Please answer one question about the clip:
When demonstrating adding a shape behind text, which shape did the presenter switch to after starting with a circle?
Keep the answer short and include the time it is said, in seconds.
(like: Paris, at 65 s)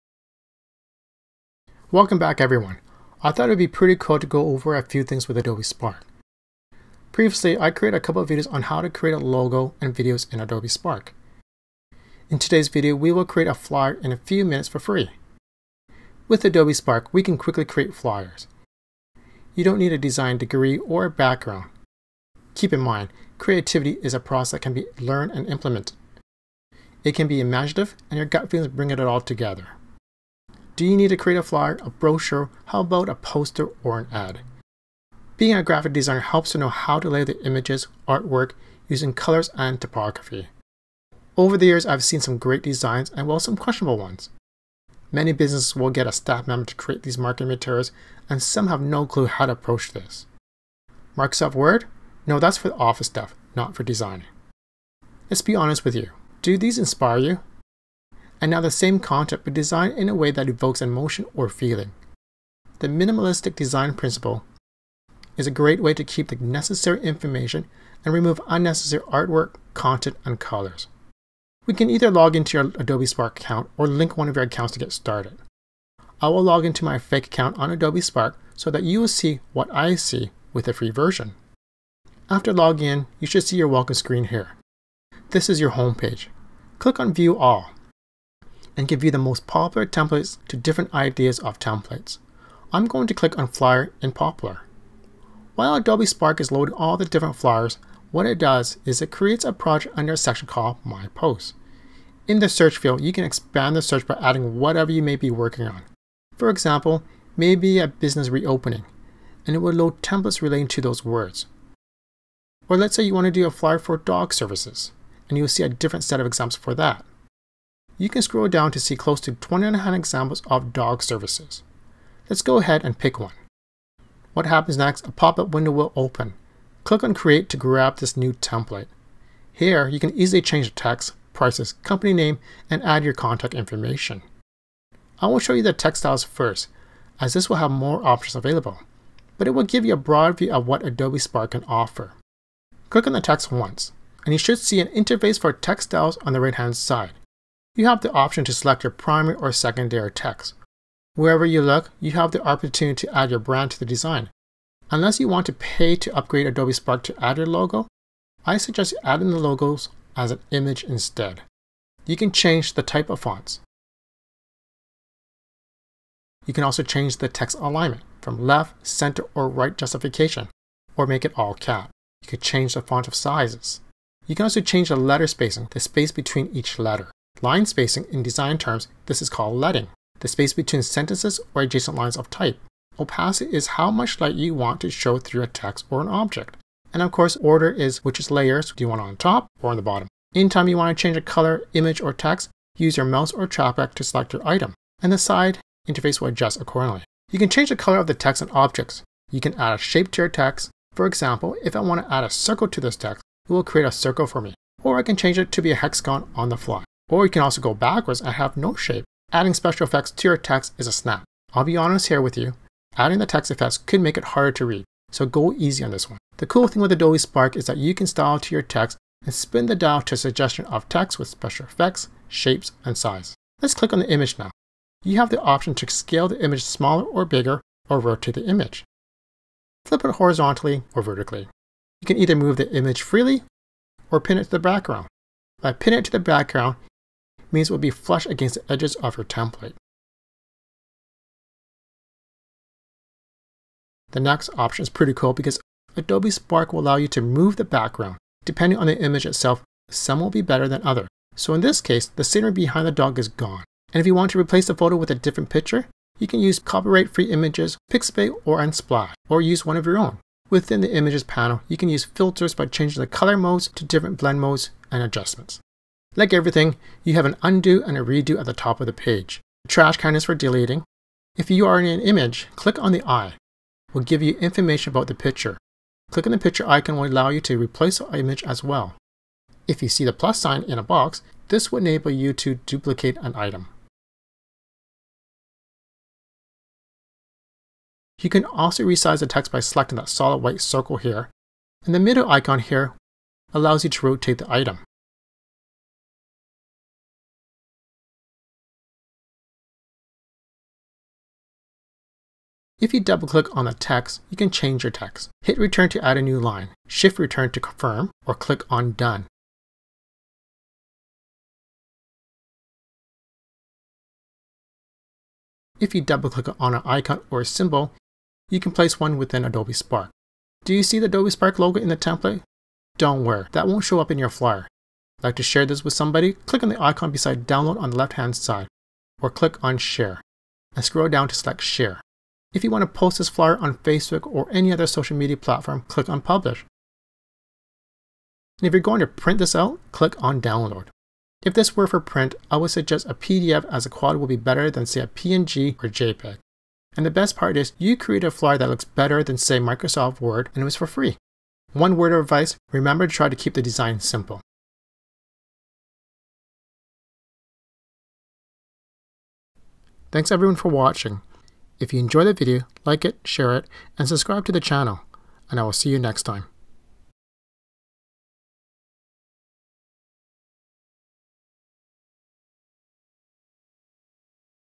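Hexagon, at 205 s.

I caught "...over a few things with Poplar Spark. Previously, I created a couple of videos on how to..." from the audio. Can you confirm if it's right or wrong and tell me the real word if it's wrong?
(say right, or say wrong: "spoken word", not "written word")
wrong: "Adobe", not "Poplar".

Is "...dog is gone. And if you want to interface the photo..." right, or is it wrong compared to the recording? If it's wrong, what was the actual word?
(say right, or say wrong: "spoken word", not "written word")
wrong: "replace", not "interface".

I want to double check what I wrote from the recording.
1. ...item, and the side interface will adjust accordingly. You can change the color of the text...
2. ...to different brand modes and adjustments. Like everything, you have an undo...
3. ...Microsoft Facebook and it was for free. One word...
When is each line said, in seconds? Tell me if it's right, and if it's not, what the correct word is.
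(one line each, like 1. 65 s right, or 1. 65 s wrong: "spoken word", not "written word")
1. 194 s right
2. 263 s wrong: "blend", not "brand"
3. 349 s wrong: "Word", not "Facebook".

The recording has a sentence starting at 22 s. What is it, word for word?
Keep in mind, creativity is a process that can be learned and implemented.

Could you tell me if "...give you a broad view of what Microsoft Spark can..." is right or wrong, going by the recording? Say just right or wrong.
wrong.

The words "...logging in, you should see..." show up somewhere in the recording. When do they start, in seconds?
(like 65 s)
82 s.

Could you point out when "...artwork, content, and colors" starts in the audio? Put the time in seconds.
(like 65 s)
69 s.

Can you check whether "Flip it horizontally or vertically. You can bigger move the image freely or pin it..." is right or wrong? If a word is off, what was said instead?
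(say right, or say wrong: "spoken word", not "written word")
wrong: "either", not "bigger".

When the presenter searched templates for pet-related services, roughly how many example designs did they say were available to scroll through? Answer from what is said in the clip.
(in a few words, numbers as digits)
29.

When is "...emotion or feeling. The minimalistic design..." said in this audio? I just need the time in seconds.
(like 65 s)
60 s.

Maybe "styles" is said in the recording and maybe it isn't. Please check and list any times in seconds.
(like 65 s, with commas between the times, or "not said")
136 s, 145 s, 218 s.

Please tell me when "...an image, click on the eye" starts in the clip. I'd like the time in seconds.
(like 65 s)
271 s.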